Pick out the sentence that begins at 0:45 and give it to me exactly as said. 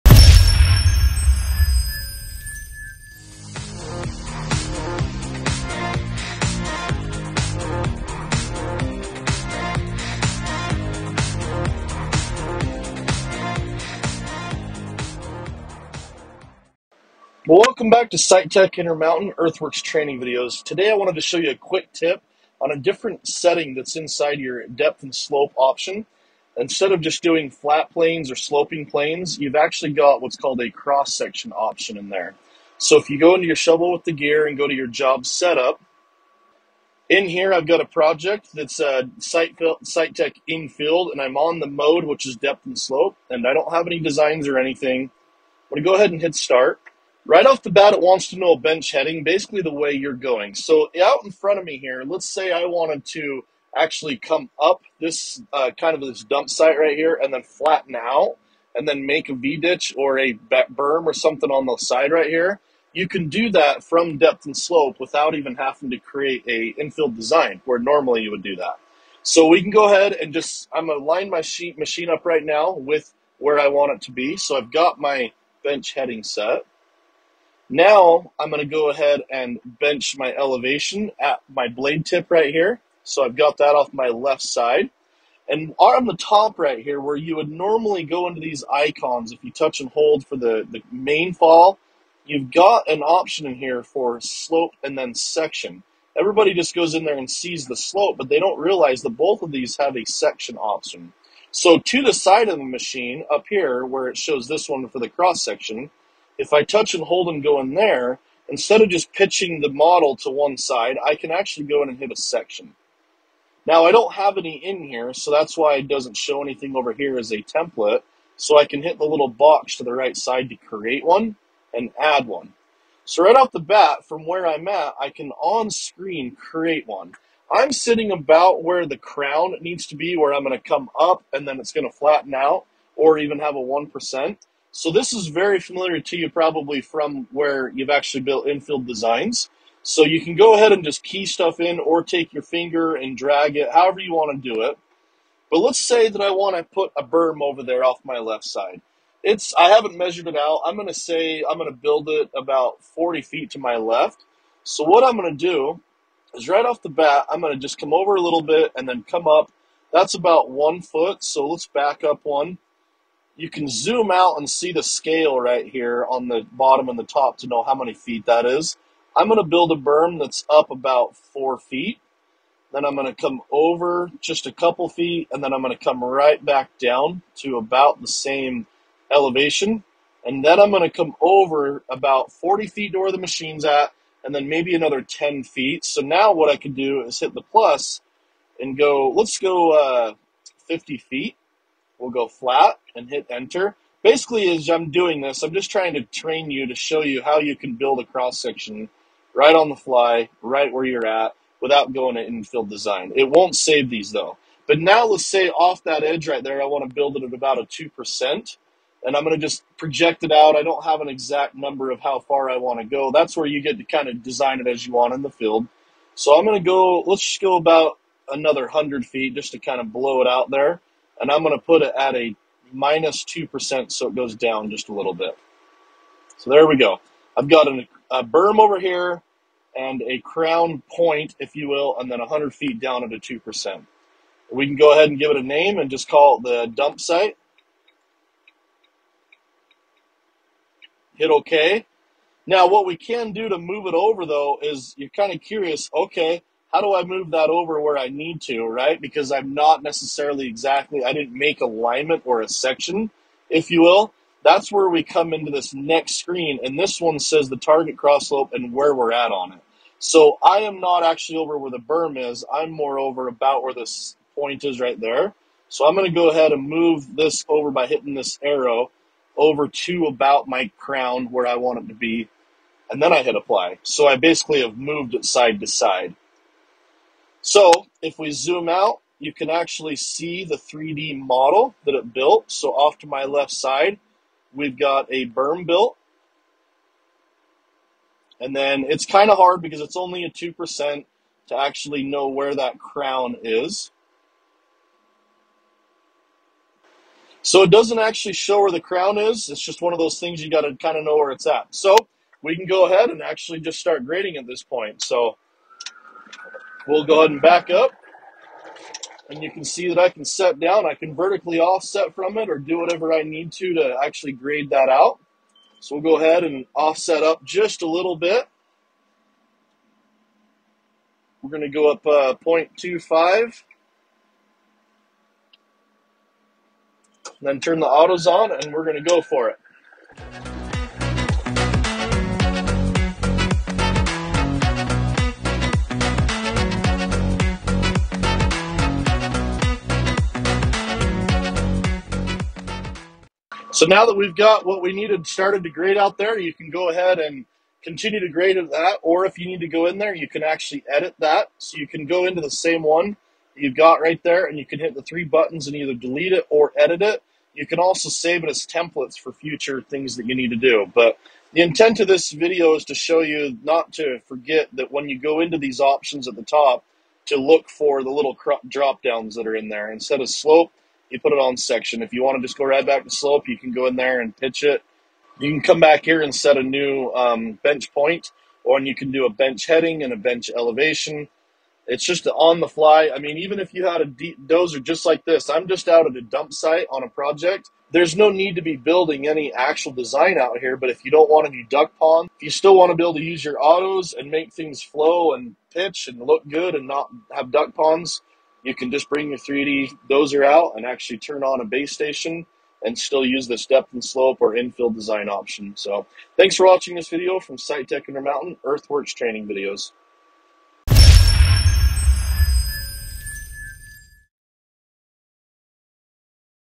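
I'm gonna go ahead and hit start.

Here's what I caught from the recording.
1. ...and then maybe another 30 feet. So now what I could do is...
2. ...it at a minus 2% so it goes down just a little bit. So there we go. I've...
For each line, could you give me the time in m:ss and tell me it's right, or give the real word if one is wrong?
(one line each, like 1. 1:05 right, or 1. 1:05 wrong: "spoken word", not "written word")
1. 3:04 wrong: "10", not "30"
2. 3:41 right.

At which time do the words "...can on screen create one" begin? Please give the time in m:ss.
2:05.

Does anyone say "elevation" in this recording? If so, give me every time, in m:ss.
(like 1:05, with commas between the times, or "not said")
1:20, 2:59, 6:20.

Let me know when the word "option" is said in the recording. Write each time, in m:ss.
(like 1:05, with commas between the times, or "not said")
0:25, 0:31, 1:33, 1:40, 6:05, 6:45.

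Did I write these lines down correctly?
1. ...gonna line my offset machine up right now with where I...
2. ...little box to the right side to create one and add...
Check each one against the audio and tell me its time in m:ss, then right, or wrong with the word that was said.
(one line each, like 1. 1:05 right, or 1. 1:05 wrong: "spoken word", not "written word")
1. 1:10 wrong: "sheet", not "offset"
2. 1:59 right.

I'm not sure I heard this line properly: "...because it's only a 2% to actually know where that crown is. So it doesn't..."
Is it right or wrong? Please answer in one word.
right.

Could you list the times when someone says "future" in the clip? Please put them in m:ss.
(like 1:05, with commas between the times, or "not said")
5:59.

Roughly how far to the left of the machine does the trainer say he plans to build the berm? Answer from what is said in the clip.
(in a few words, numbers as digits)
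40 feet.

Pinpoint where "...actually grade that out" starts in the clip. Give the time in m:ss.
5:14.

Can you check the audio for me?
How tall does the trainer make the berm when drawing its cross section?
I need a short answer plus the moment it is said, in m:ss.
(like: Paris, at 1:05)
4 feet, at 2:50.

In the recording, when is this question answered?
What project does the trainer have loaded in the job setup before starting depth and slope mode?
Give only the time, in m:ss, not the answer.
0:39.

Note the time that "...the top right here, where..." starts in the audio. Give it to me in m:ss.
1:26.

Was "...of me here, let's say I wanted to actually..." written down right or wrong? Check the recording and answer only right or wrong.
right.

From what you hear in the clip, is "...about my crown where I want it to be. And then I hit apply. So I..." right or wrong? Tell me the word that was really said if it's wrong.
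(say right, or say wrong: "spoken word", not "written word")
right.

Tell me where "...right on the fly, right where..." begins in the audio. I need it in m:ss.
3:19.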